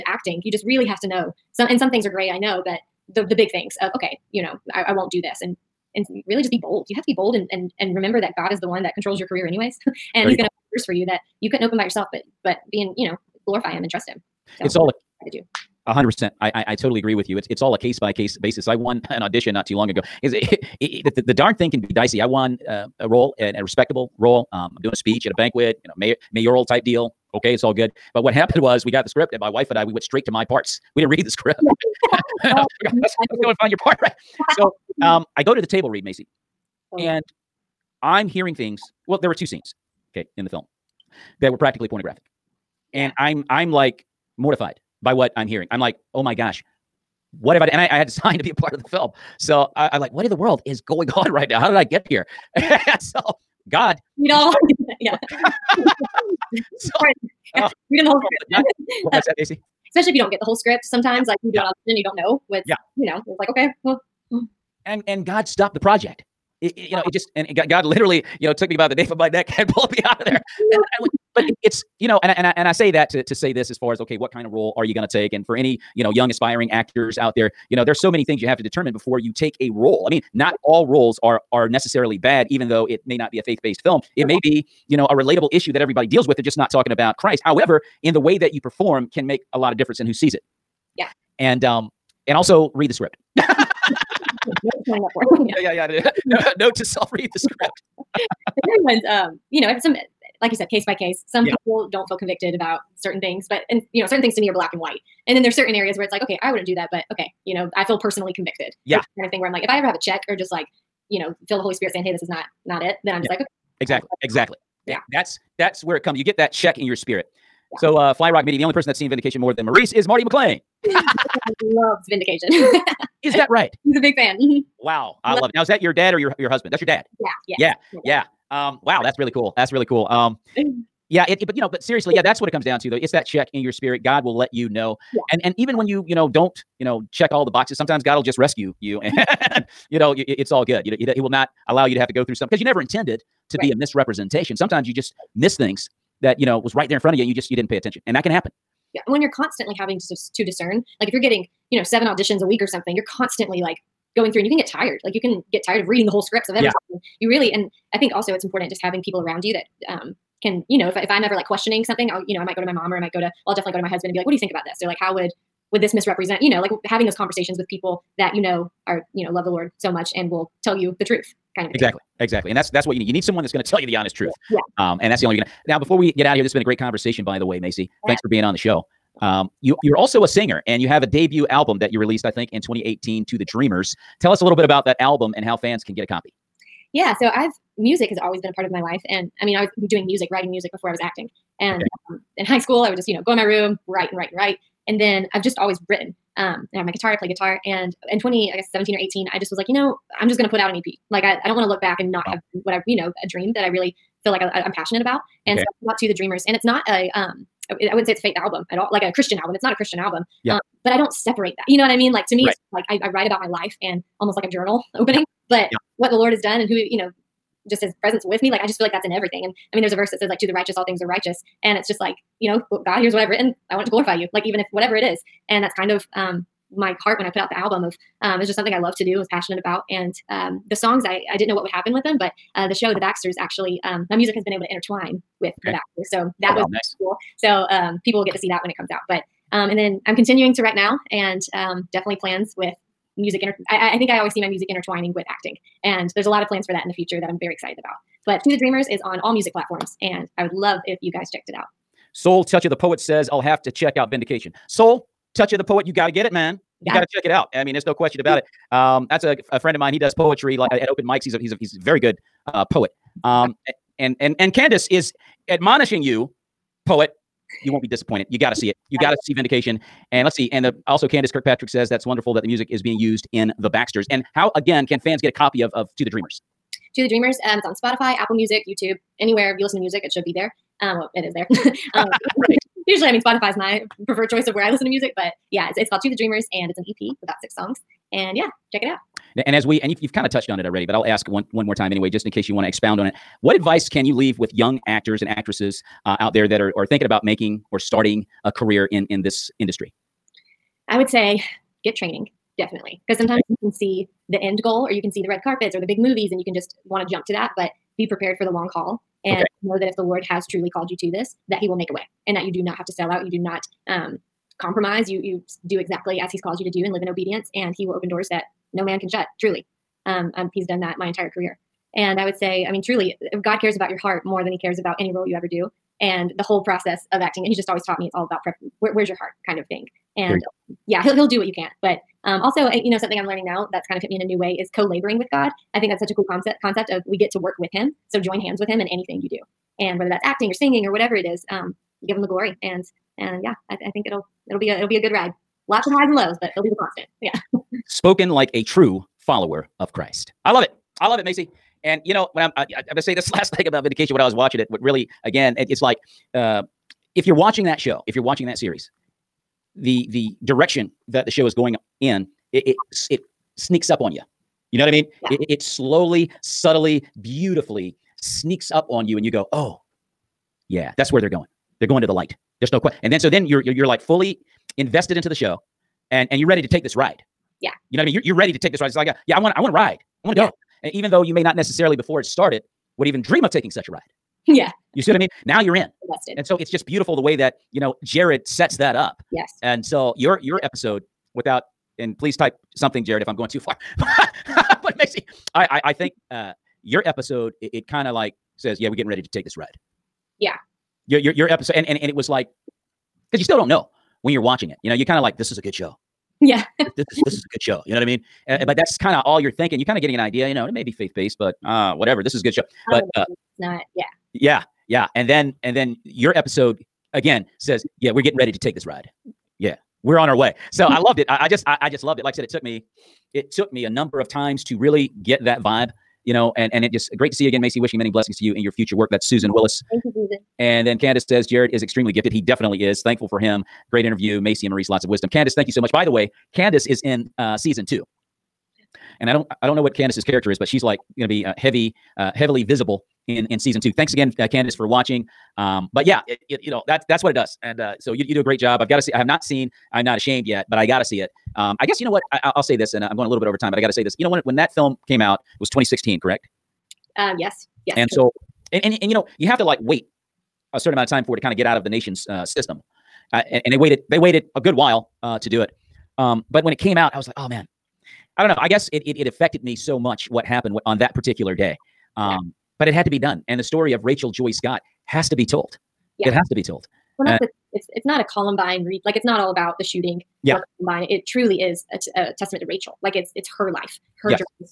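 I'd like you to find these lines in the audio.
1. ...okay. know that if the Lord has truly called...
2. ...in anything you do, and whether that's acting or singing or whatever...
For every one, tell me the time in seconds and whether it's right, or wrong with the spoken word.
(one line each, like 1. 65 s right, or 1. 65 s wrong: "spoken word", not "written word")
1. 309 s right
2. 338 s right.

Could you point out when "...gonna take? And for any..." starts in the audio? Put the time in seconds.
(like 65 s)
74 s.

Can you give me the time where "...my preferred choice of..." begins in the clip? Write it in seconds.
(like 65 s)
283 s.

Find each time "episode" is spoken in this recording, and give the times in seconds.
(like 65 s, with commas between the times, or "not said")
390 s, 397 s, 401 s, 416 s.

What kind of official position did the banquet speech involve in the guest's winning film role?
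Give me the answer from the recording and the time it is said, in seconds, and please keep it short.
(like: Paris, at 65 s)
Mayoral, at 26 s.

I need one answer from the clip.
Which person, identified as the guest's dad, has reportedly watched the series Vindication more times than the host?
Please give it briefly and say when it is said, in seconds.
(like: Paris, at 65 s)
Marty McClain, at 120 s.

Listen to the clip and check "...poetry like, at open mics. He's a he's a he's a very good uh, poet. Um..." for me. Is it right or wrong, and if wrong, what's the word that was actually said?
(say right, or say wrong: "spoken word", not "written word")
right.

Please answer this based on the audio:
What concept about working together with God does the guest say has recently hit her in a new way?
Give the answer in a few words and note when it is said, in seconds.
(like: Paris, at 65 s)
Co-laboring, at 334 s.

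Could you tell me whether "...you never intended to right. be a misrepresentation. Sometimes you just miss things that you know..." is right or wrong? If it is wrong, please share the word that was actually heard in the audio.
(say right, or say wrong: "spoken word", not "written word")
right.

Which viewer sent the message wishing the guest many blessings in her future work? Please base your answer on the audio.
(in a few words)
Susan Willis.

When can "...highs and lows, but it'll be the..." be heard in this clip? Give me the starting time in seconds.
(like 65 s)
345 s.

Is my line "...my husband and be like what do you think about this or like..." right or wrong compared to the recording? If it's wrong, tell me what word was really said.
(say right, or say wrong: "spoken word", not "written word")
right.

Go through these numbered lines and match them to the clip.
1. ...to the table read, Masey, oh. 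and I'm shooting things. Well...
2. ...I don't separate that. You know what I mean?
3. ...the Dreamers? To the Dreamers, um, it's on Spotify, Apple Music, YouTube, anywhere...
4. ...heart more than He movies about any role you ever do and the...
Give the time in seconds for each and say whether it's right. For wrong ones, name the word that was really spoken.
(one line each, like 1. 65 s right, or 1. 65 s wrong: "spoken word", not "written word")
1. 35 s wrong: "hearing", not "shooting"
2. 210 s right
3. 276 s right
4. 323 s wrong: "cares", not "movies".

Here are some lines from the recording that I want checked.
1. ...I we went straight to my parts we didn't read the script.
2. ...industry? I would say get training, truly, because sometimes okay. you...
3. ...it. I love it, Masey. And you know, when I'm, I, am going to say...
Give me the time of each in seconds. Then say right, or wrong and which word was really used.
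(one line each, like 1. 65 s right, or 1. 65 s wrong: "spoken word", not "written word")
1. 29 s right
2. 299 s wrong: "definitely", not "truly"
3. 350 s right.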